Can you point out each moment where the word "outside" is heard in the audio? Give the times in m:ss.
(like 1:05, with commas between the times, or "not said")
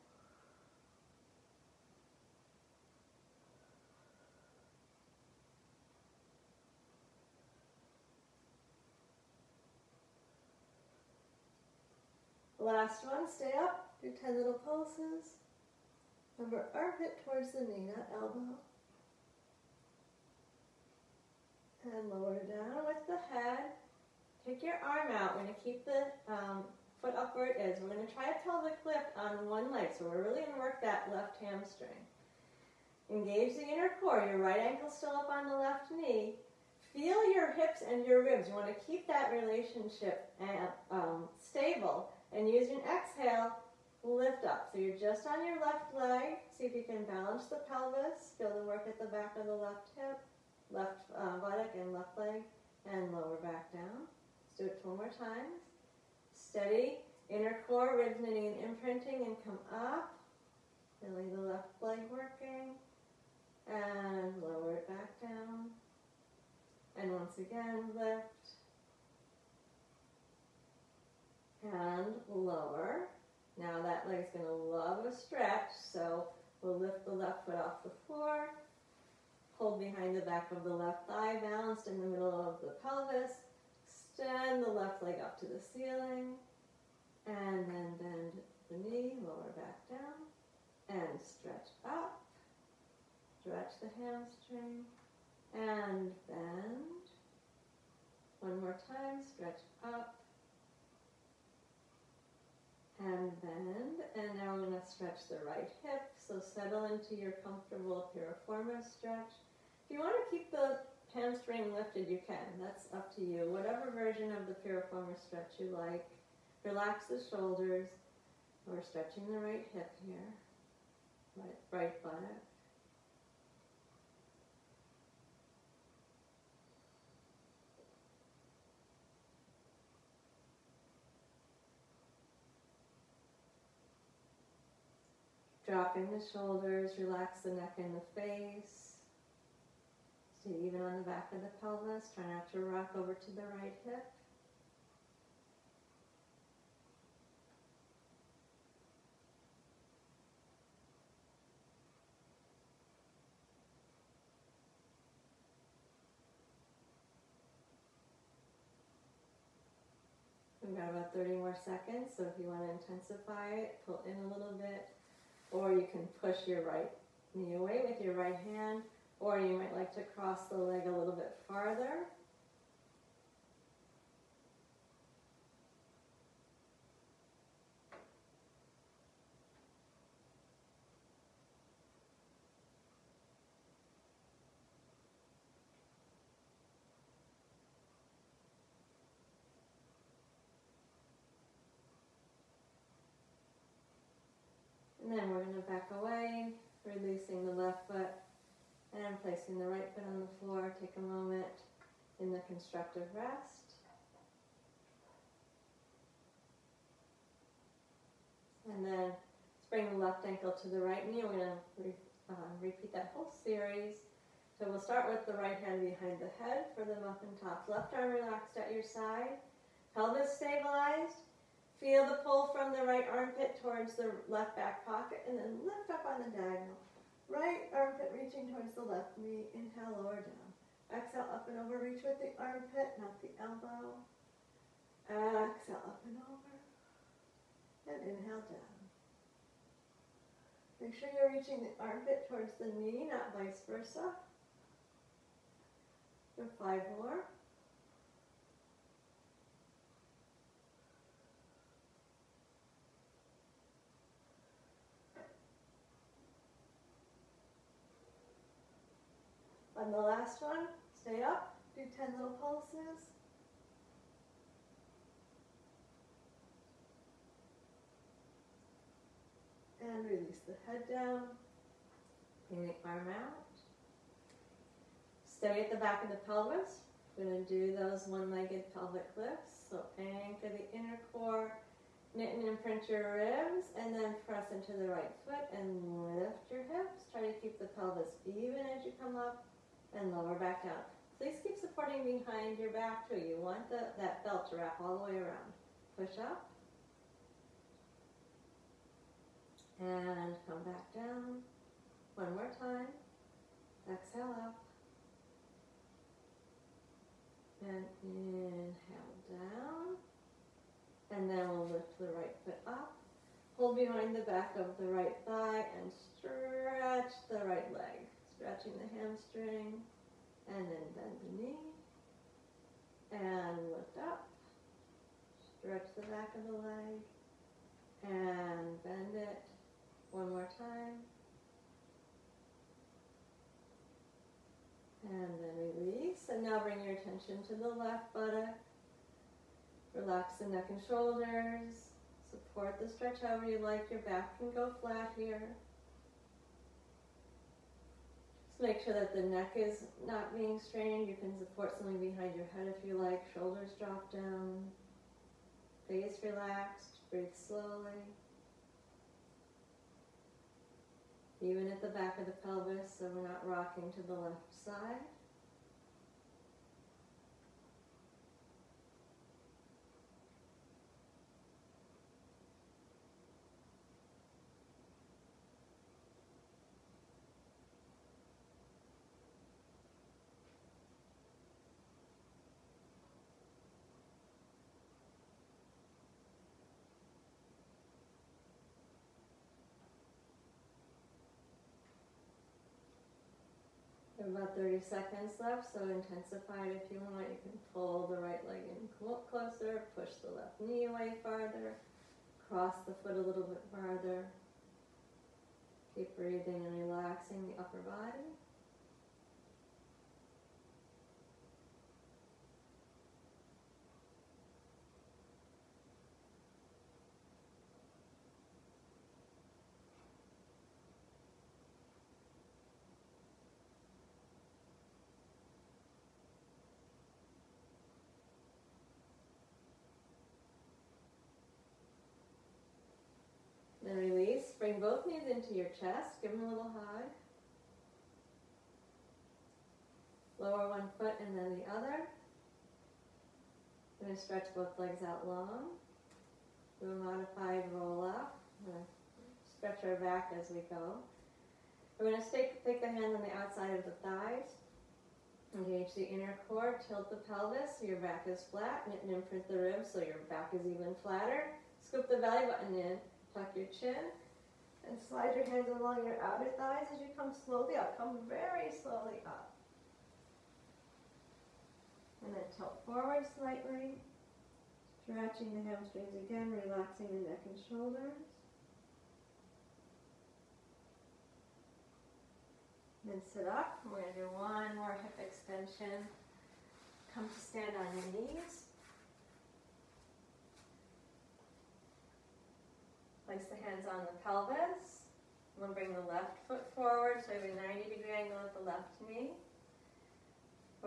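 7:33.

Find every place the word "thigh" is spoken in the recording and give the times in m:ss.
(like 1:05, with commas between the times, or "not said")
1:21, 5:15, 7:34, 7:46.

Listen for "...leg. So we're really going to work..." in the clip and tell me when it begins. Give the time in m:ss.
0:29.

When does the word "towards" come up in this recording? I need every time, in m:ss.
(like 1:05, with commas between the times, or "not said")
0:17, 3:43, 3:48, 4:02.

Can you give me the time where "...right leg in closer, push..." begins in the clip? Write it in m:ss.
6:38.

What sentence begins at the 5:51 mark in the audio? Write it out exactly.
You can support something behind your head if you like.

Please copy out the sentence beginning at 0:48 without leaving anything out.
Feel the work at the back of the left hip left uh, buttock and left leg, and lower back down.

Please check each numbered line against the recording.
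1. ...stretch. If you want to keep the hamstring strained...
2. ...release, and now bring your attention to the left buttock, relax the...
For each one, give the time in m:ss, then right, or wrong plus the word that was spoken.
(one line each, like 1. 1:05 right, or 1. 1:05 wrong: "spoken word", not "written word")
1. 1:48 wrong: "lifted", not "strained"
2. 5:35 right.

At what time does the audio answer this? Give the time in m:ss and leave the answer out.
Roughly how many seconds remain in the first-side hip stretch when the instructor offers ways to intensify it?
2:41.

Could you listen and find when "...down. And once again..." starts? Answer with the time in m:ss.
1:05.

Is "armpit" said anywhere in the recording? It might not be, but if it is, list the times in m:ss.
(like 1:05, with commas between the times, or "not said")
0:16, 3:43, 3:47, 3:52, 4:01.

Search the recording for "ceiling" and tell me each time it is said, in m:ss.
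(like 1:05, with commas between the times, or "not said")
1:25.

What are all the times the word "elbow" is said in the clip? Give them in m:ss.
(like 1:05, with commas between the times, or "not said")
0:18, 3:53.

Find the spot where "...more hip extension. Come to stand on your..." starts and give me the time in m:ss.
8:04.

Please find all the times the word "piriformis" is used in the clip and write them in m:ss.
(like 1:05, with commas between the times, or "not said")
1:48, 1:54.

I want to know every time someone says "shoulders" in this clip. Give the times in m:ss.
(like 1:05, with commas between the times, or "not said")
1:57, 2:16, 5:40, 5:53, 7:57.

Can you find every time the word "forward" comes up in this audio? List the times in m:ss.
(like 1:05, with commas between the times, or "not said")
7:52, 8:16.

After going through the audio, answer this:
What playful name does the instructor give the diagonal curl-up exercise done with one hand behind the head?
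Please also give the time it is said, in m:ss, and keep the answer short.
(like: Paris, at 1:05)
muffin tops, at 3:37.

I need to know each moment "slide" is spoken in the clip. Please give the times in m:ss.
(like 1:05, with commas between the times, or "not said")
7:45.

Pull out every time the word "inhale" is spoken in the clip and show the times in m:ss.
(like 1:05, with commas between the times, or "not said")
3:49, 3:58, 5:08.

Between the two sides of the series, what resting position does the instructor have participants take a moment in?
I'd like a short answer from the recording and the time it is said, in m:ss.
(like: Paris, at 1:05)
constructive rest, at 3:22.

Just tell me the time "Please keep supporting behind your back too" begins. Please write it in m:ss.
4:51.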